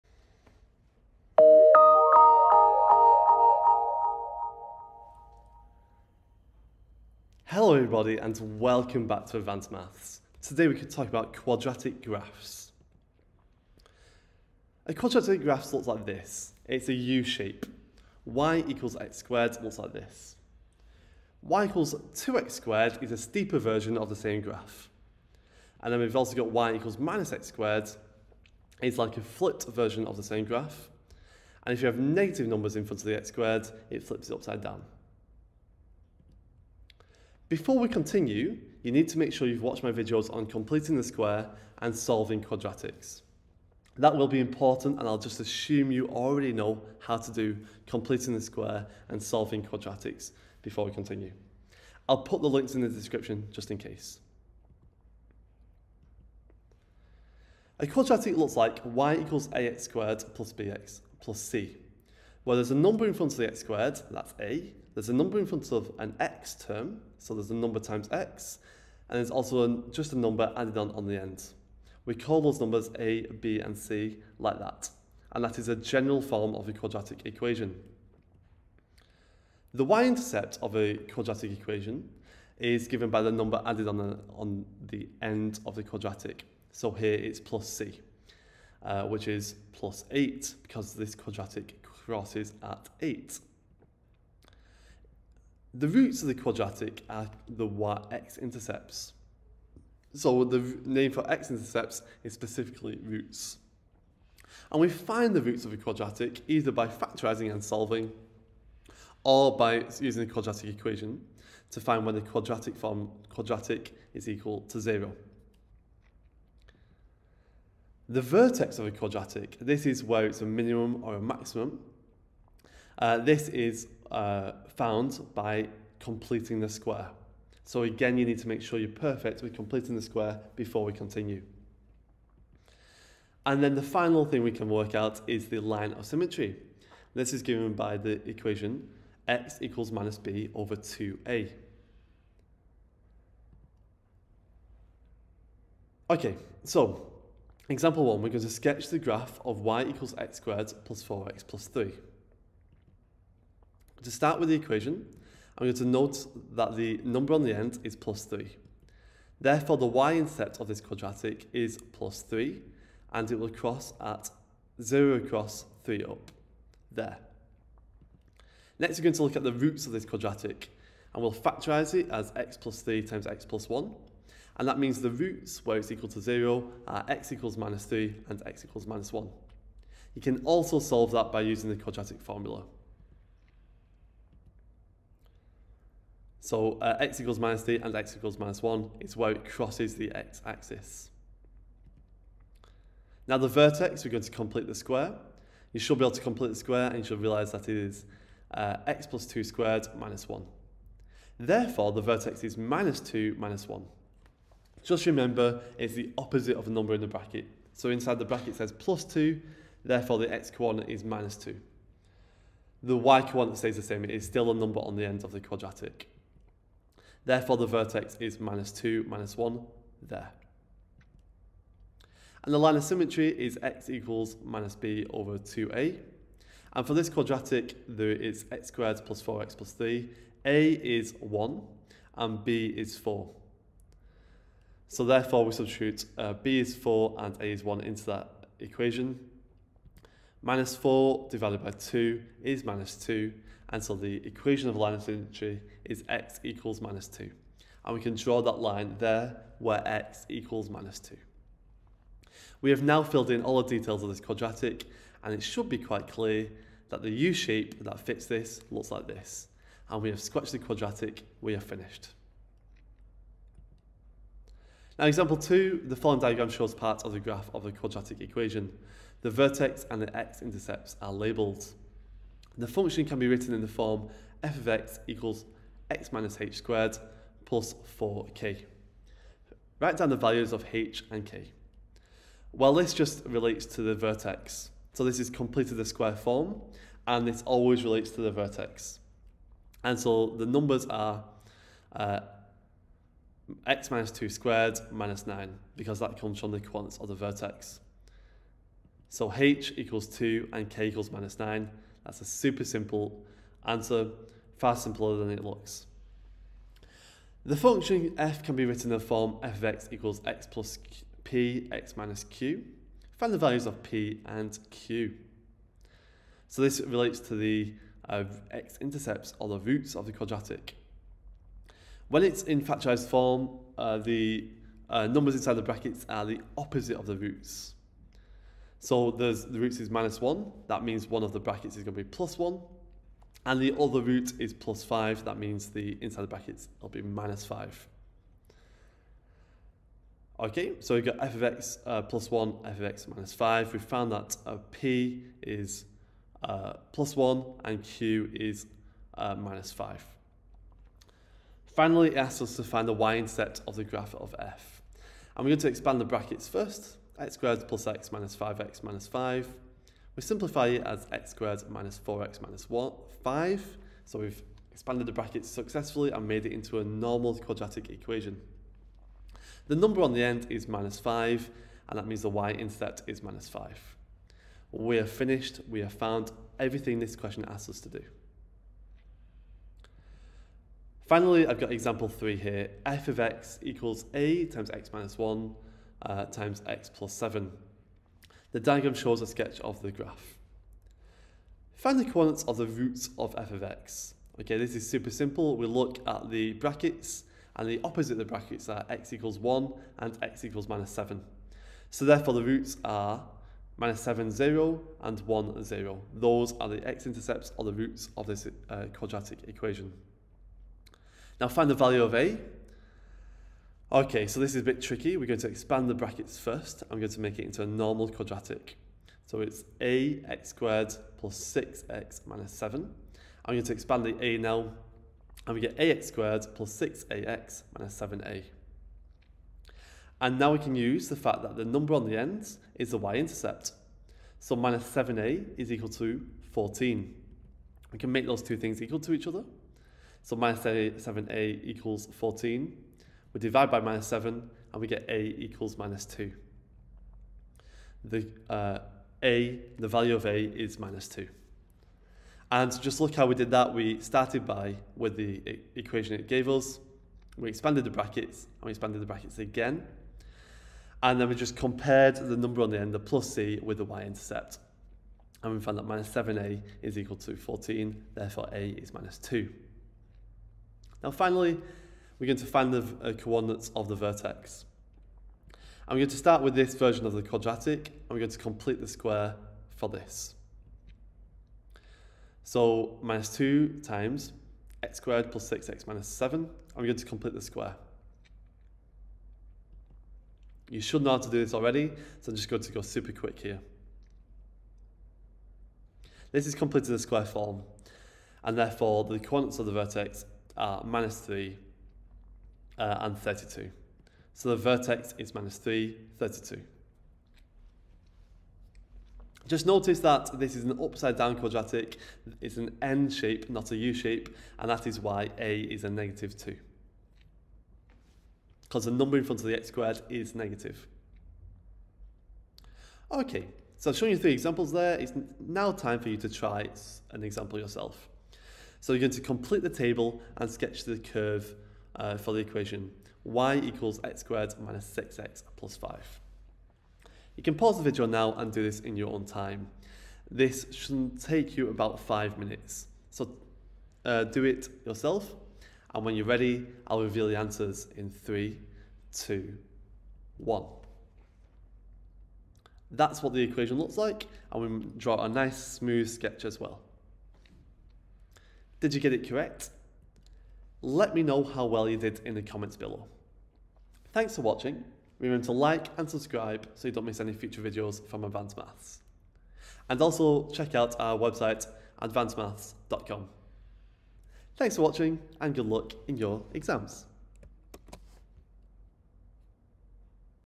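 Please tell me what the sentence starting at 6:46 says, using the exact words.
Those are the x-intercepts or the roots of this uh, quadratic equation.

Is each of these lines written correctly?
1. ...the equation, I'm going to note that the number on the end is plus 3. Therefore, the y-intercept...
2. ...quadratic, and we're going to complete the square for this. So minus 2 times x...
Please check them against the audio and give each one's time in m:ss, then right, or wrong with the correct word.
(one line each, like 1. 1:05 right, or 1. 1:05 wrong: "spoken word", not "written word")
1. 2:34 right
2. 7:57 right.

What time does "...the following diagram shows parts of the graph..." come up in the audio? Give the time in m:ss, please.
4:25.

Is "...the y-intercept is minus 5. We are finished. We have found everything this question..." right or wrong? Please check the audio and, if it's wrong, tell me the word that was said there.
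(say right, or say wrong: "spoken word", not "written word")
right.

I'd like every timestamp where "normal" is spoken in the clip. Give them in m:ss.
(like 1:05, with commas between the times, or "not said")
6:06, 6:57.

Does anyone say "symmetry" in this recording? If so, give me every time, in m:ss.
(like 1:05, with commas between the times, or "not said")
2:16, 3:42, 4:05.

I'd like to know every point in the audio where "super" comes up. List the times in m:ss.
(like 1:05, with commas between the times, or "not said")
5:02, 6:34, 8:12.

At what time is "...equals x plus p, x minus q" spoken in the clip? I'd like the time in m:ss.
5:09.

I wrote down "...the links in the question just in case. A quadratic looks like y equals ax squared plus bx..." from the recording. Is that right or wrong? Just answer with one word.
wrong.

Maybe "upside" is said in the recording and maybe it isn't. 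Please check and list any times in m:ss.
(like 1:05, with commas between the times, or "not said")
0:34, 8:30.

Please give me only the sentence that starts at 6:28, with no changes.
The diagram shows a sketch of the graph.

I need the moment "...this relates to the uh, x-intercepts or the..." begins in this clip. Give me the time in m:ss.
5:16.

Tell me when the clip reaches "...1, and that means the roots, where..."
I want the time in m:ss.
2:53.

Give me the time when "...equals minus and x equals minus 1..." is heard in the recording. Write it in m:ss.
3:07.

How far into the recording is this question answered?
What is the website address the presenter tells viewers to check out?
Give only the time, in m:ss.
9:32.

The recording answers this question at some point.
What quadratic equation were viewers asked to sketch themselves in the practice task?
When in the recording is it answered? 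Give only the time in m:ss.
8:53.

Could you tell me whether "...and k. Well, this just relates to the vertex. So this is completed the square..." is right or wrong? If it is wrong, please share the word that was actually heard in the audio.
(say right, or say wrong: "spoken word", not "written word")
right.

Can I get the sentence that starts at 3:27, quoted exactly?
So inside the bracket says plus 2, therefore the x coordinate is minus 2.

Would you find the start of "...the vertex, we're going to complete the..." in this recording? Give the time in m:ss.
3:13.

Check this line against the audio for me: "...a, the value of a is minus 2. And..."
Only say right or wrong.
right.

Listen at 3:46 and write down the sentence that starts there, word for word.
And for this quadratic, there is x squared plus 4x plus 3.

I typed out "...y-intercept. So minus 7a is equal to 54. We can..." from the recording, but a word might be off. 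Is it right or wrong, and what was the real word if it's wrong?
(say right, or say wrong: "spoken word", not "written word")
wrong: "14", not "54".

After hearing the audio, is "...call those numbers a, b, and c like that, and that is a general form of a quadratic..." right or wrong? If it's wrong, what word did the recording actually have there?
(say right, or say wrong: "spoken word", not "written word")
right.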